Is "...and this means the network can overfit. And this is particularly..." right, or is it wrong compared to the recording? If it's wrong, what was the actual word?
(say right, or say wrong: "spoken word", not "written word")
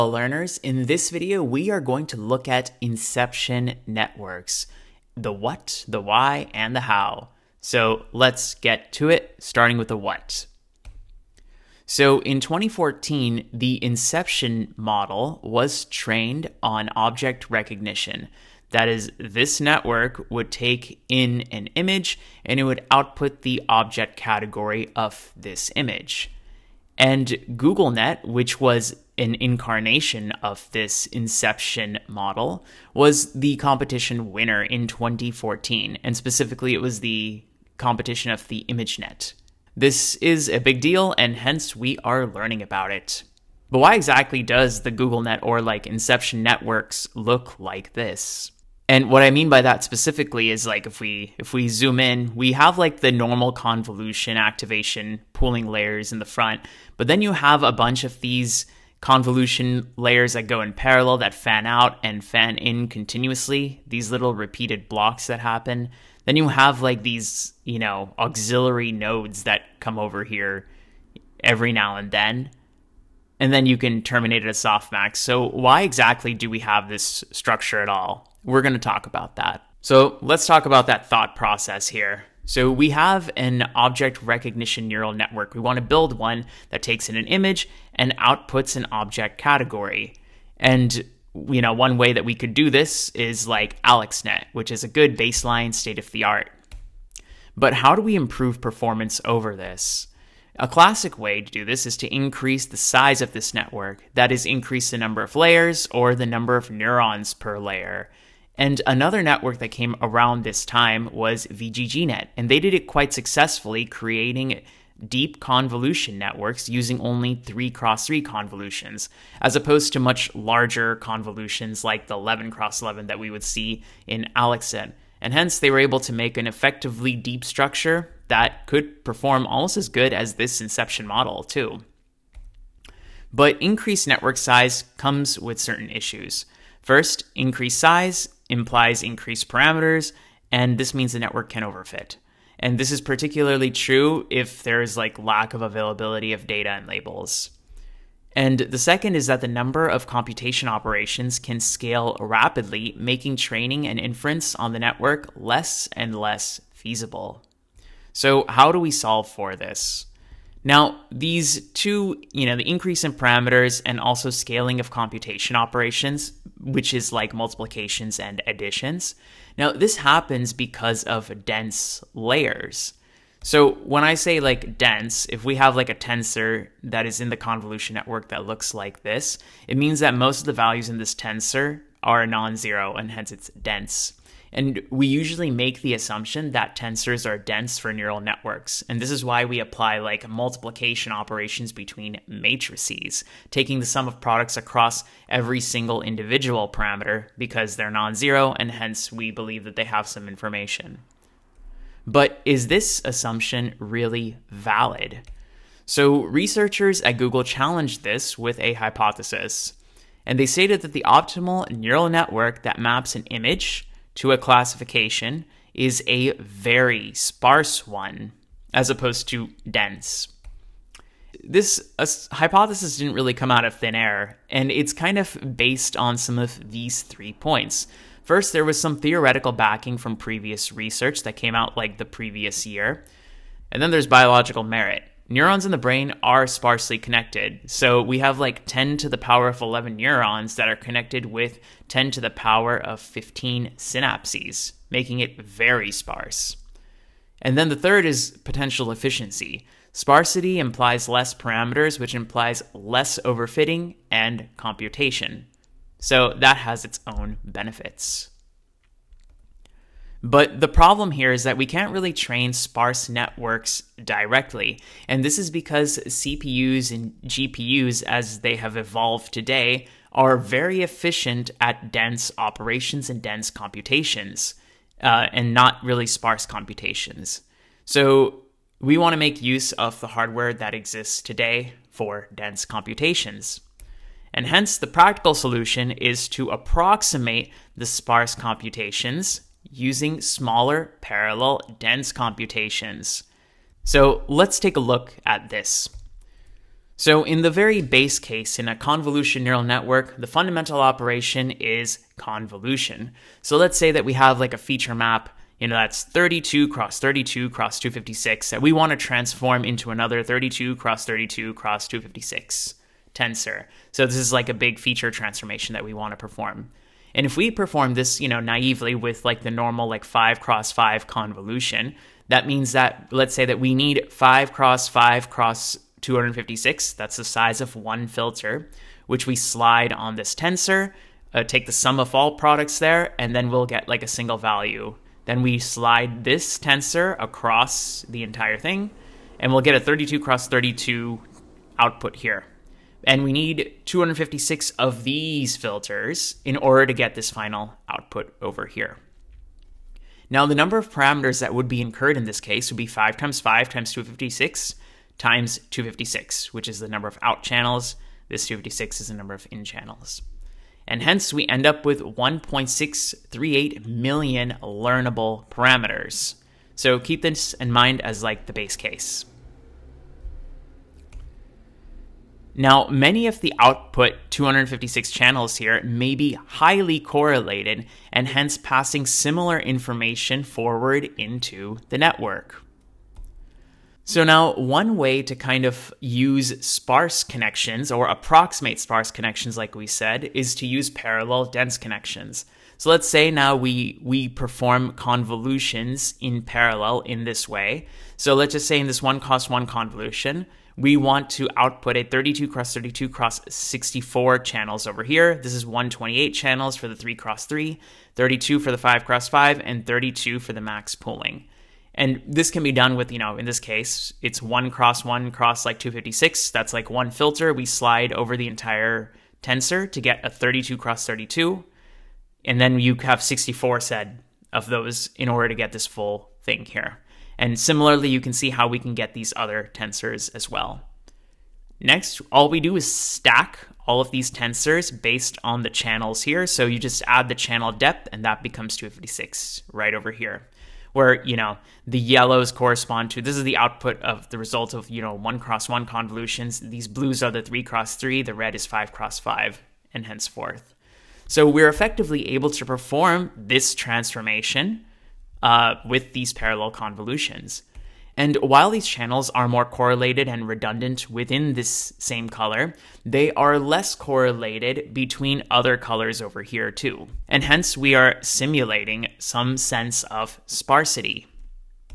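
right.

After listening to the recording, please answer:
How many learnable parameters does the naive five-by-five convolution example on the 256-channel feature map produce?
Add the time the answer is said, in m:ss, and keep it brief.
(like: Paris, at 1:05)
1.638 million, at 6:01.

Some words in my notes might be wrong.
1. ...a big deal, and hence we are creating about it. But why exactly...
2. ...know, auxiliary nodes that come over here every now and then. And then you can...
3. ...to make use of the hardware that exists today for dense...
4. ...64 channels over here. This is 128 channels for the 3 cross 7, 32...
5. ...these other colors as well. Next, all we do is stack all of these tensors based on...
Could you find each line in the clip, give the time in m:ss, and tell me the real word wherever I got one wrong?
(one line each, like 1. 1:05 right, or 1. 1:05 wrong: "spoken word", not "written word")
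1. 0:40 wrong: "learning", not "creating"
2. 1:07 right
3. 4:39 right
4. 6:43 wrong: "3", not "7"
5. 7:09 wrong: "tensors", not "colors".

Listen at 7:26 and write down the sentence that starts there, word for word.
These blues are the three cross three, the red is five cross five and henceforth.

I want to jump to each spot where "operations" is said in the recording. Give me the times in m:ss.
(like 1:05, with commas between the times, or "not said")
2:30, 2:45, 3:11, 4:32, 5:00.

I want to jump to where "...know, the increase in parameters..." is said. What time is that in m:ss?
2:42.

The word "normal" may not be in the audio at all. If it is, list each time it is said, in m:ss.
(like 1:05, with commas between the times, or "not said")
0:53, 5:19.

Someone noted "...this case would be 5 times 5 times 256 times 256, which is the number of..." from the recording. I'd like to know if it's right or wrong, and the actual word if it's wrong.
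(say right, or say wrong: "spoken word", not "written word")
right.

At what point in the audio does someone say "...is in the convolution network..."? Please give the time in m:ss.
2:57.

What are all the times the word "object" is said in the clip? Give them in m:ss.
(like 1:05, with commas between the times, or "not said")
0:16, 0:23, 1:23, 1:28.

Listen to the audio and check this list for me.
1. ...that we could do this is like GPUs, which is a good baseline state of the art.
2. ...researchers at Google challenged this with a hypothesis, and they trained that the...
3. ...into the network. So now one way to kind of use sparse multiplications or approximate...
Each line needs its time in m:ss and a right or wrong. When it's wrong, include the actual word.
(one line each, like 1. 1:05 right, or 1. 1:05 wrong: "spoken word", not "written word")
1. 1:32 wrong: "AlexNet", not "GPUs"
2. 3:26 wrong: "stated", not "trained"
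3. 6:21 wrong: "connections", not "multiplications".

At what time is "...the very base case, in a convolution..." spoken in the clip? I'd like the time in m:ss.
4:57.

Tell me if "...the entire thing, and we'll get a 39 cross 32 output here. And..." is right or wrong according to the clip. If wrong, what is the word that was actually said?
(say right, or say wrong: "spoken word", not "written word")
wrong: "32", not "39".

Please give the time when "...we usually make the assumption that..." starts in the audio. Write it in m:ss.
3:04.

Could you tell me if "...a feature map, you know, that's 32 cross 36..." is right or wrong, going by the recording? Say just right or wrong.
wrong.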